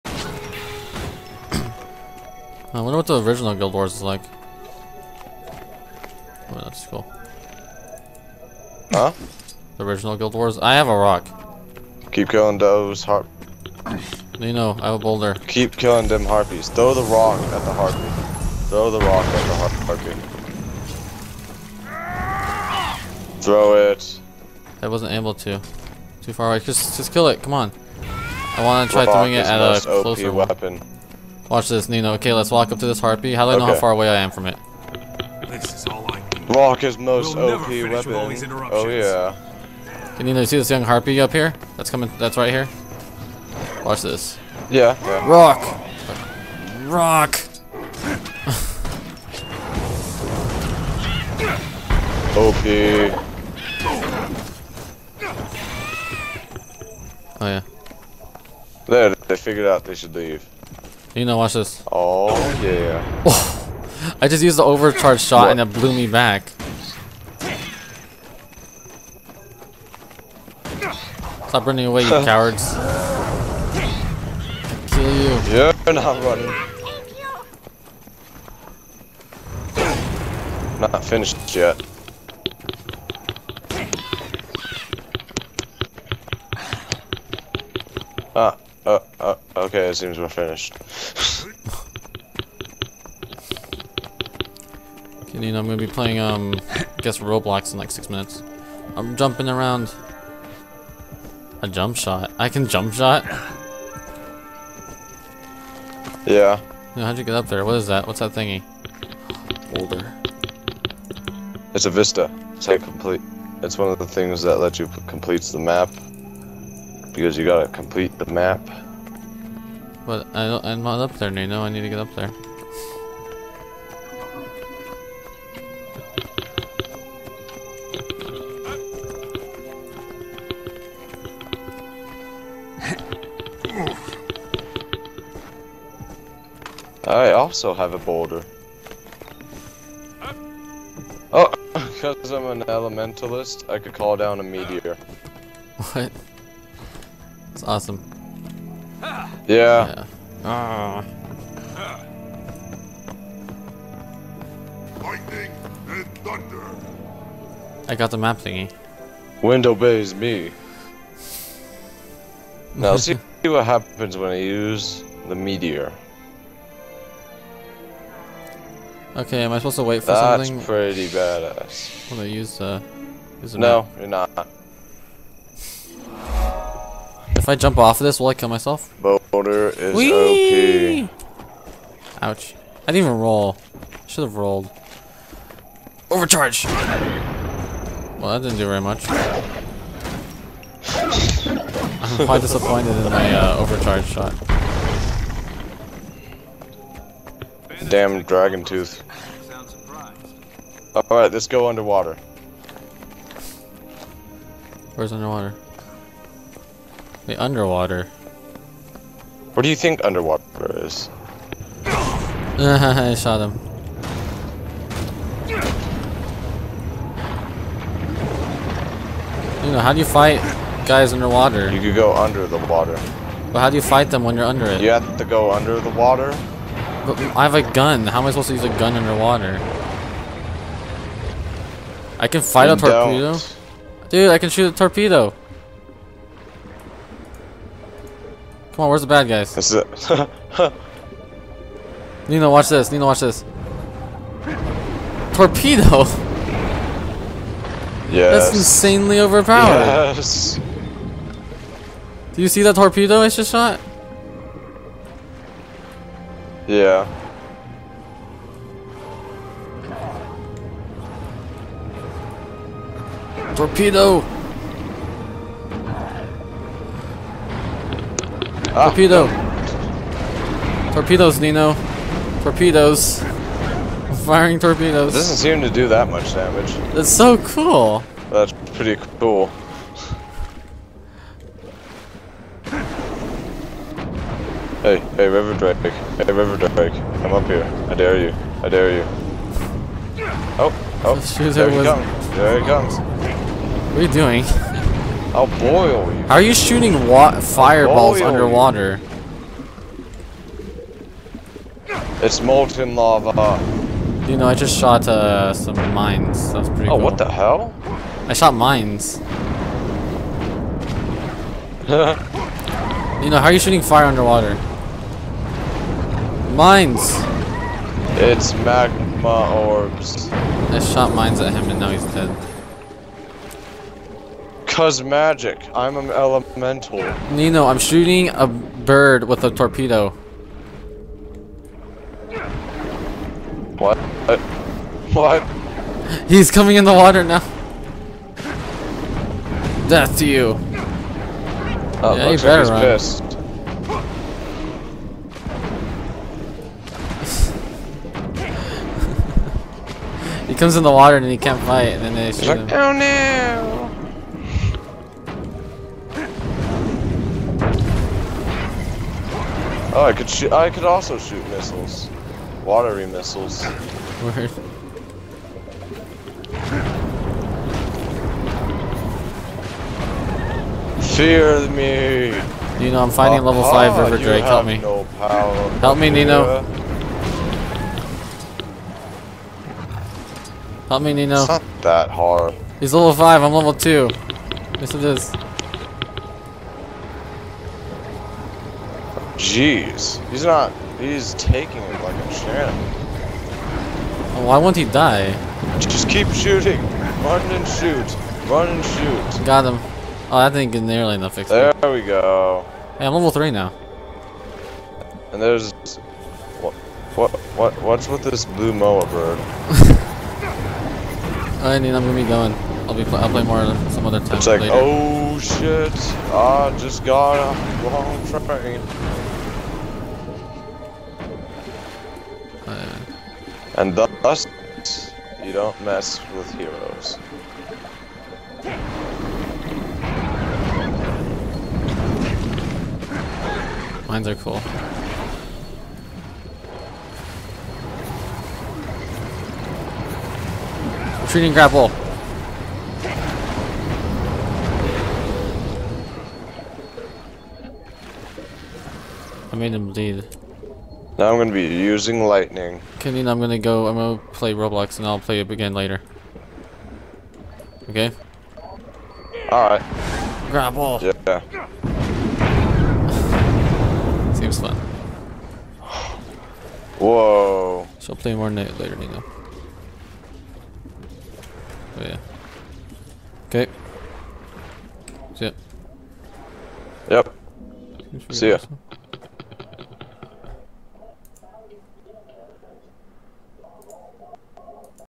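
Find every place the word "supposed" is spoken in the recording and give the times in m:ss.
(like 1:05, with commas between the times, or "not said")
2:49, 3:48.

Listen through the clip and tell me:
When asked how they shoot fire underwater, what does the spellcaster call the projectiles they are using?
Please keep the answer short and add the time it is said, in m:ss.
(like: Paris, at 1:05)
Magma orbs, at 5:18.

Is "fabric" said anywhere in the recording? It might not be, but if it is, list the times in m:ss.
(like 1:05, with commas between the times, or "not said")
not said.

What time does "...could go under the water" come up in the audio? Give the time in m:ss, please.
3:41.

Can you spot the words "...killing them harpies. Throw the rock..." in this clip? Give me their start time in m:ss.
0:15.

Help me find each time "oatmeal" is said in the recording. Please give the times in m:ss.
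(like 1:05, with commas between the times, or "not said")
not said.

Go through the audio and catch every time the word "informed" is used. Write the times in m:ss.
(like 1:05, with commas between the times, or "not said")
not said.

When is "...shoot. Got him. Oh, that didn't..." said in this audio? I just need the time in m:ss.
6:38.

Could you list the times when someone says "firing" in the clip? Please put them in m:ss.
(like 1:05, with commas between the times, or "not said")
4:34.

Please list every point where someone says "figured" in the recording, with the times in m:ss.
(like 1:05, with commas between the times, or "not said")
0:59.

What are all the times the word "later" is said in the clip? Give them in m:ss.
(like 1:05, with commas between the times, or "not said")
6:54, 7:35, 7:48.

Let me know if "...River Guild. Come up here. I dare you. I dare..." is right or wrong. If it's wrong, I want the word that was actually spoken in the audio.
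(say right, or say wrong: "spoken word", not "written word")
wrong: "Drake", not "Guild".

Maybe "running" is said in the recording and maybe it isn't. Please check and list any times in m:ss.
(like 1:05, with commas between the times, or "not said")
1:11, 1:16.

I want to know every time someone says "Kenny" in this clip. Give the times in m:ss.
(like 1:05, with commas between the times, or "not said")
7:32.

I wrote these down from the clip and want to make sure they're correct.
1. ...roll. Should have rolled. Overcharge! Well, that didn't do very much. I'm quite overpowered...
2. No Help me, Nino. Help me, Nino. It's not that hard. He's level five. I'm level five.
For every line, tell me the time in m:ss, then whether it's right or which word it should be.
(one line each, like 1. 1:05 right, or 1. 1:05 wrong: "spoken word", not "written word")
1. 3:03 wrong: "disappointed", not "overpowered"
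2. 6:14 wrong: "two", not "five".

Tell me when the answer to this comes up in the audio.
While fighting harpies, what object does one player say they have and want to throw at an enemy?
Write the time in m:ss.
0:10.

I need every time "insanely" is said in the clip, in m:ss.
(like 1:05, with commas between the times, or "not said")
4:08.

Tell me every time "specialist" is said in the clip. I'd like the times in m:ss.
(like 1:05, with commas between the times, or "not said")
not said.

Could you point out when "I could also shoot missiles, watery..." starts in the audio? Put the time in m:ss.
6:00.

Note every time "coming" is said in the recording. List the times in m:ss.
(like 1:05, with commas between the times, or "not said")
0:41, 5:36.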